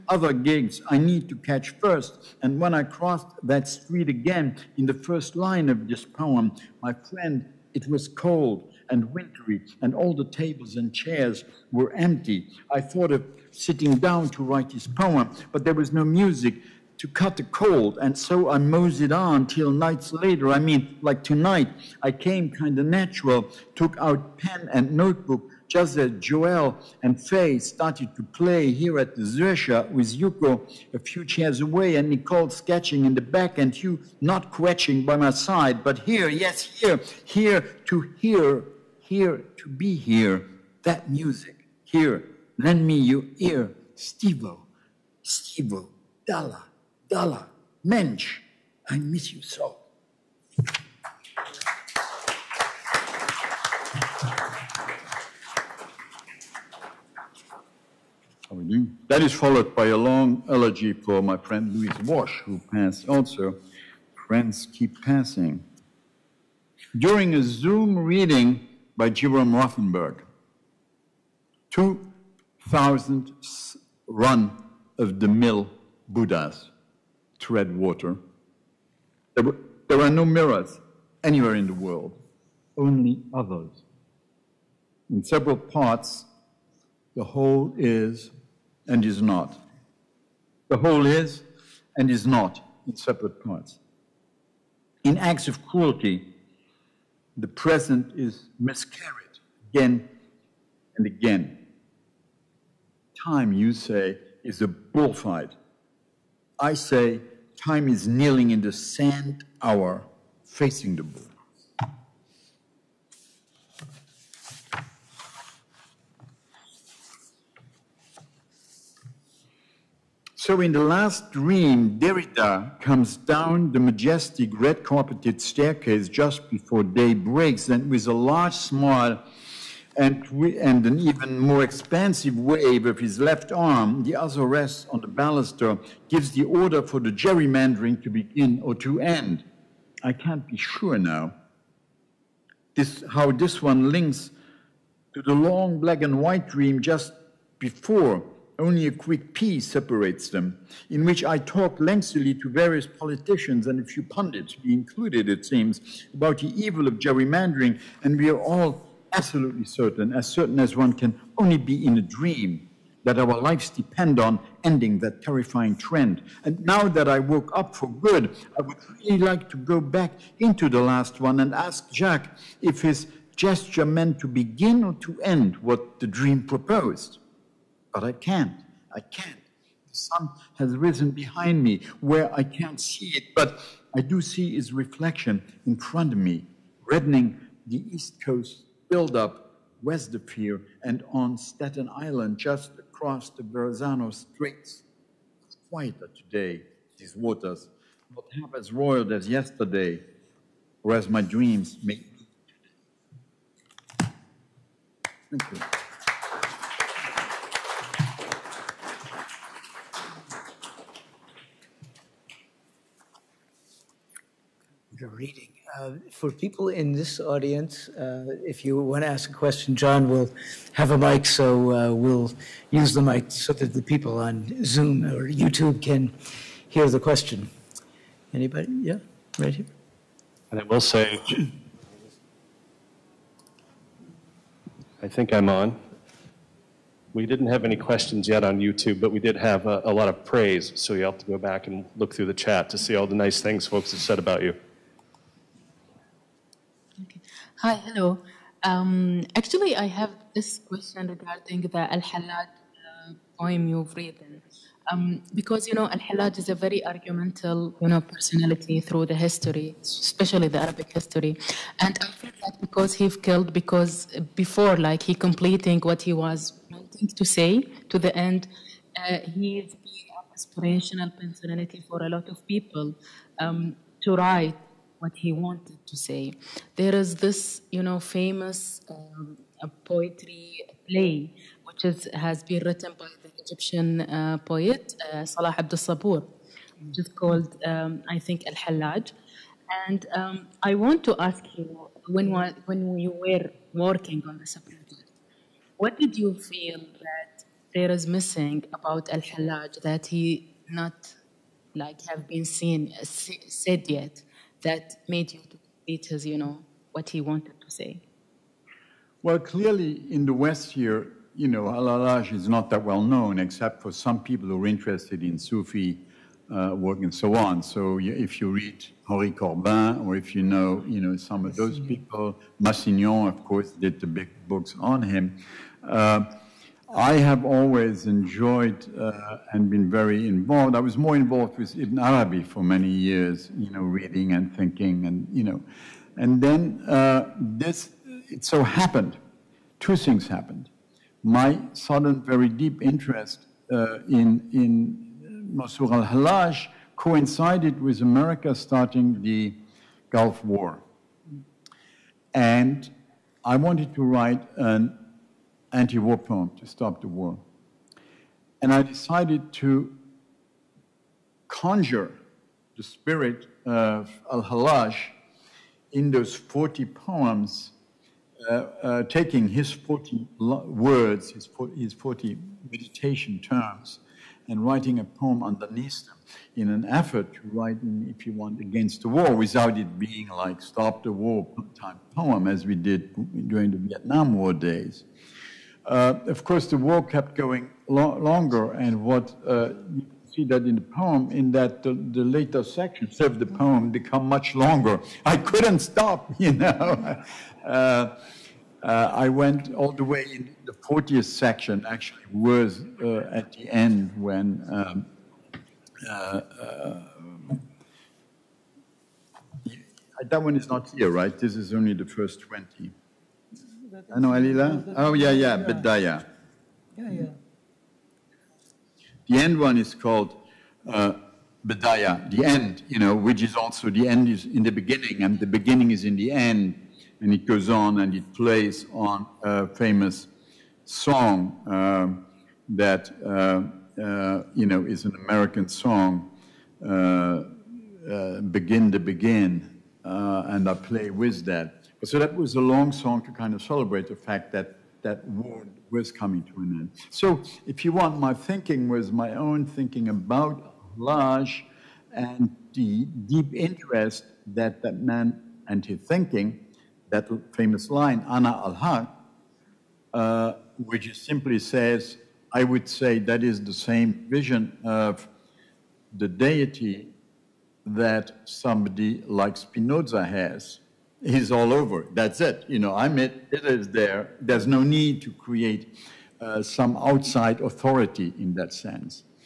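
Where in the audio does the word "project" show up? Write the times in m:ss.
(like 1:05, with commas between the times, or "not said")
4:54.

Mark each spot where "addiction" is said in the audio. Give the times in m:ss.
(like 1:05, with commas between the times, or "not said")
not said.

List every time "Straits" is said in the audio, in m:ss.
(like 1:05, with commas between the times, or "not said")
3:14.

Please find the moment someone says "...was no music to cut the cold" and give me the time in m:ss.
0:15.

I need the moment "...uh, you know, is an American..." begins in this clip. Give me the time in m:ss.
7:13.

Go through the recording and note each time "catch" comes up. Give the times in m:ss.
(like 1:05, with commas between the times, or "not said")
0:01.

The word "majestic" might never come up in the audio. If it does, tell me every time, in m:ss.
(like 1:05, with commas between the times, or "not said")
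2:03.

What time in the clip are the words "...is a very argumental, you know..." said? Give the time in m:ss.
4:16.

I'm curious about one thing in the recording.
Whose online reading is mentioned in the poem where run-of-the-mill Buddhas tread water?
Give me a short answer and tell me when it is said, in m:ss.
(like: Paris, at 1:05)
Jerome Rothenberg, at 1:09.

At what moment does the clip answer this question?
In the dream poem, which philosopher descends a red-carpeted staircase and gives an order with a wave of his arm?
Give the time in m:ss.
2:01.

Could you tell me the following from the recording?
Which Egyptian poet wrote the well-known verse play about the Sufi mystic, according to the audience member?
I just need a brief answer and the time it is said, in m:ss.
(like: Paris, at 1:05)
Salah Abdel Sabur, at 4:45.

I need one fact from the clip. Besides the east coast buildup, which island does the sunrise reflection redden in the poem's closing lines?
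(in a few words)
Staten Island.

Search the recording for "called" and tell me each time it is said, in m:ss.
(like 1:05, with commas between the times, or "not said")
4:47, 6:59.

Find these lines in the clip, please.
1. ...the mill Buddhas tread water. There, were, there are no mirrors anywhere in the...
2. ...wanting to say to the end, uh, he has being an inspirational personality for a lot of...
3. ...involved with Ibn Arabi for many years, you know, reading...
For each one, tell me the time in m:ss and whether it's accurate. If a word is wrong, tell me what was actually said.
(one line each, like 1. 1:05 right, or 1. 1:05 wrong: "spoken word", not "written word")
1. 1:15 right
2. 4:26 right
3. 5:31 right.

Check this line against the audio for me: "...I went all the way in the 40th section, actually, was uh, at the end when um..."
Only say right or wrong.
right.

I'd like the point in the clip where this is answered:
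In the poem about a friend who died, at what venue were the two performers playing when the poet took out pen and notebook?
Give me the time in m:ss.
0:29.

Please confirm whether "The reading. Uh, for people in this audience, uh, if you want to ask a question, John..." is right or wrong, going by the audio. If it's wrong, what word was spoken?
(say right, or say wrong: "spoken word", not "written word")
right.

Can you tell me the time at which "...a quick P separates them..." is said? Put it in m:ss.
2:28.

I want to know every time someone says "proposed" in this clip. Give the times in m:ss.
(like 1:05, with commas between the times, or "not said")
2:56.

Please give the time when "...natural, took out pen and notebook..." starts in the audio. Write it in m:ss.
0:22.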